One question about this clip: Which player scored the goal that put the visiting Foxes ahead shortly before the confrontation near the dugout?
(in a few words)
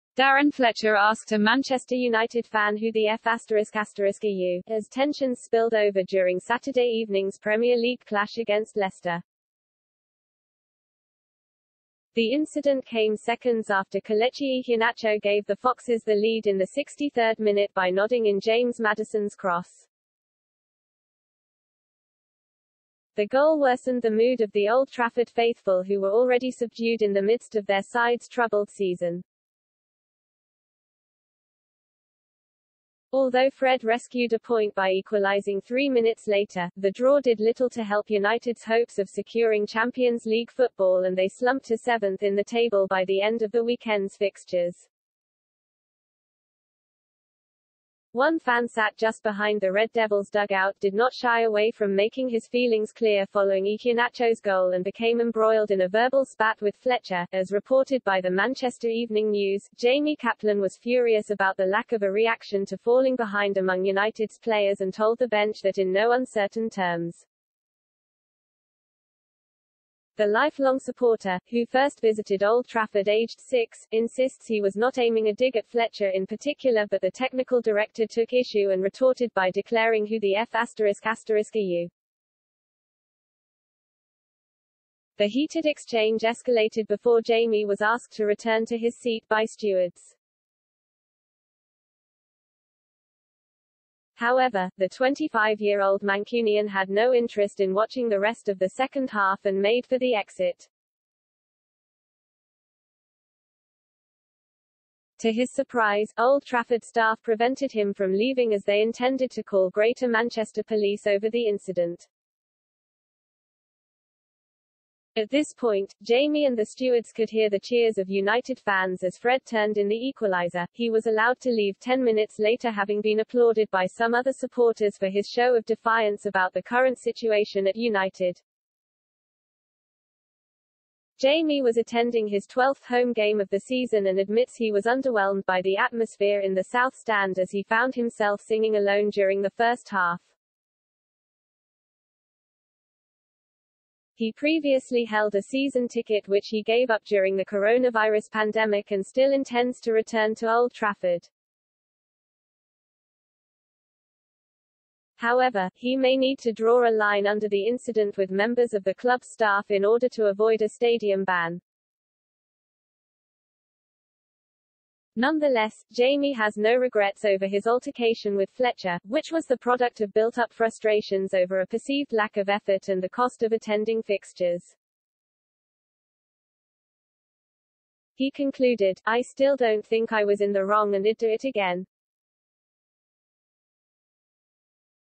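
Kelechi Iheanacho.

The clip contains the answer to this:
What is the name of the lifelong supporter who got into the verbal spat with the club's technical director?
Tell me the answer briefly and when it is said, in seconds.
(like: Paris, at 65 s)
Jamie Kaplan, at 59 s.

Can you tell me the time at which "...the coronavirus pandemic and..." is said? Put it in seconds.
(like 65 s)
147 s.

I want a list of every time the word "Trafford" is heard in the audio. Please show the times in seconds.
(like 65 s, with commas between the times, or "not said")
24 s, 72 s, 106 s, 150 s.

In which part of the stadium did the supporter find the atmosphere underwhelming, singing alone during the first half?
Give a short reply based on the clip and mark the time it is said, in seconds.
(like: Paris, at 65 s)
South Stand, at 136 s.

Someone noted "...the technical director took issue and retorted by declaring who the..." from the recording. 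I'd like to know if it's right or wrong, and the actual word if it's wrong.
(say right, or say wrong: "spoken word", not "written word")
right.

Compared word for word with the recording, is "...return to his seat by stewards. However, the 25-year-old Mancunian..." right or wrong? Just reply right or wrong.
right.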